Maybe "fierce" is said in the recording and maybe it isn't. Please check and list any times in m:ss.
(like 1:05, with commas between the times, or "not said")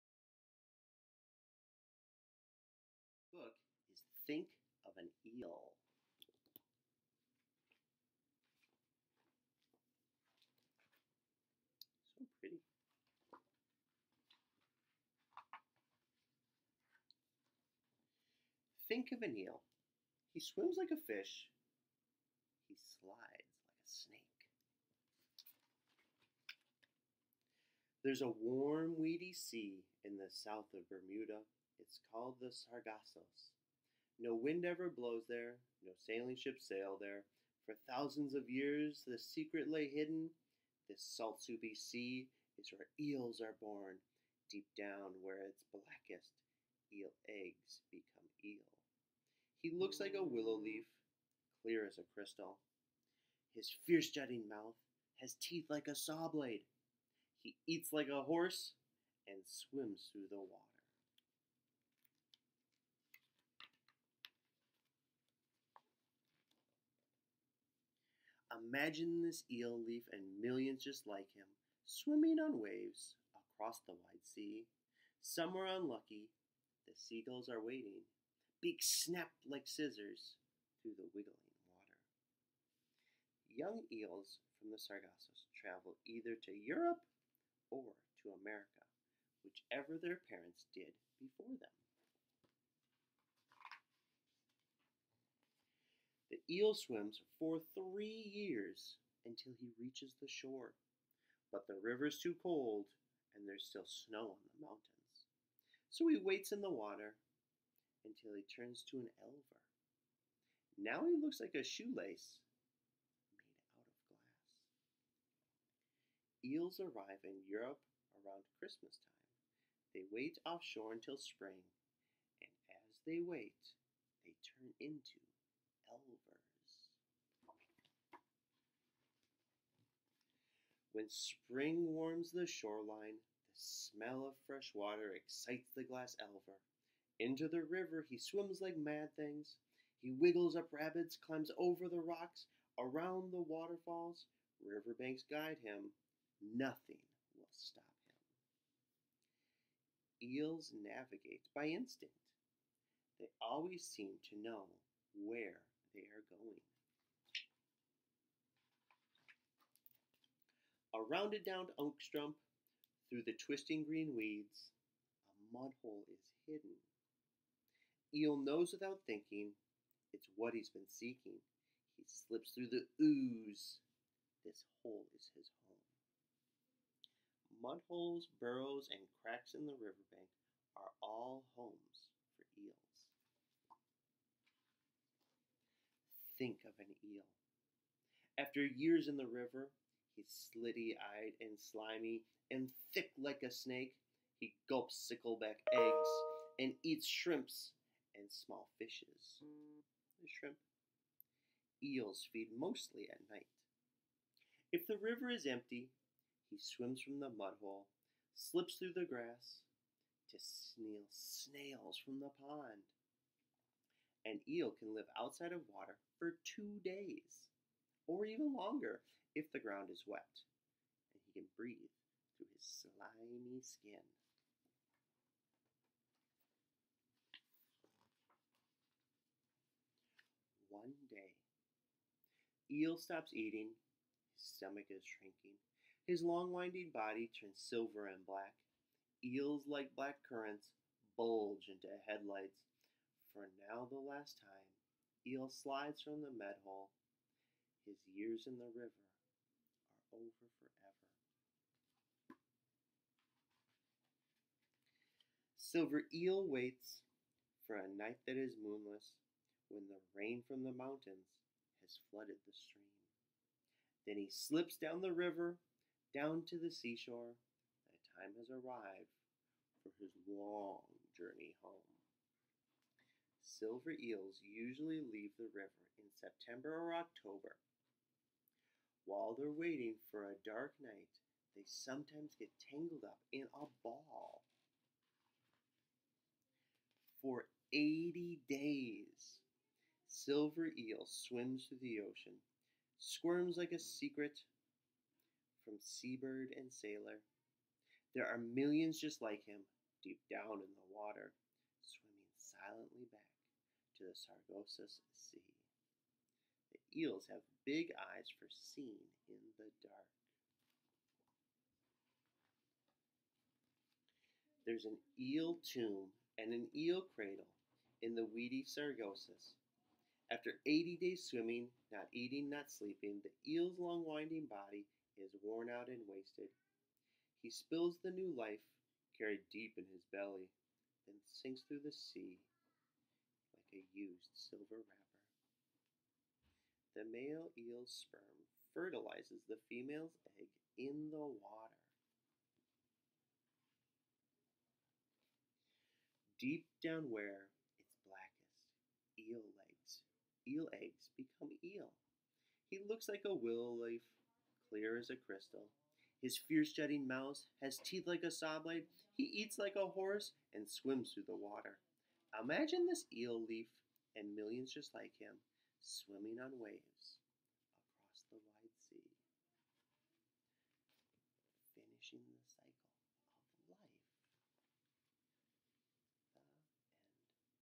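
0:53, 5:56.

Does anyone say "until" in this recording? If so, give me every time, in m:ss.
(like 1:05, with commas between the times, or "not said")
1:39, 1:48, 2:00.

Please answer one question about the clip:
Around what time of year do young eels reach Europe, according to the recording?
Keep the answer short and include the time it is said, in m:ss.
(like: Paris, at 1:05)
Christmas, at 1:58.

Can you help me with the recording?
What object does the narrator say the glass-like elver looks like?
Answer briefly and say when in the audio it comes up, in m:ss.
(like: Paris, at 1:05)
a shoelace, at 1:51.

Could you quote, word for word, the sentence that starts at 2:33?
They always seem to know where they are going.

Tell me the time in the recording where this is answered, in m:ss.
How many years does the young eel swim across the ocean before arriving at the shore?
1:37.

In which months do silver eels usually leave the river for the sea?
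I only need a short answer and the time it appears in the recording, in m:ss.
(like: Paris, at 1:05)
September or October, at 4:36.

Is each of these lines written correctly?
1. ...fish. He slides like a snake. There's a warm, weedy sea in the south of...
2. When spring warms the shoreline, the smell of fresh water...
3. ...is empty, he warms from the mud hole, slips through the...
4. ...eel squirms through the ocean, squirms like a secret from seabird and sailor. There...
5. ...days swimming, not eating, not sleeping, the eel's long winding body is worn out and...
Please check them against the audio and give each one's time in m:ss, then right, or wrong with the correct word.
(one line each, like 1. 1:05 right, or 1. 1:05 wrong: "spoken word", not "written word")
1. 0:21 right
2. 2:10 right
3. 3:25 wrong: "swims", not "warms"
4. 4:50 wrong: "swims", not "squirms"
5. 5:21 right.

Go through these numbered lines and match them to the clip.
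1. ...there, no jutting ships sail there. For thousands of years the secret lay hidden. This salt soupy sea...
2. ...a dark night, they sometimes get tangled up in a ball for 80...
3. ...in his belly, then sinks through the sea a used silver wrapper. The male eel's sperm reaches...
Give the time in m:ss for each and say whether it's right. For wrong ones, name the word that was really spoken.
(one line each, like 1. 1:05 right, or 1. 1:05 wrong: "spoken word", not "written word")
1. 0:35 wrong: "sailing", not "jutting"
2. 4:40 right
3. 5:29 wrong: "fertilizes", not "reaches".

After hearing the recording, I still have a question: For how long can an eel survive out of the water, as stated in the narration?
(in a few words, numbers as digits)
2 days.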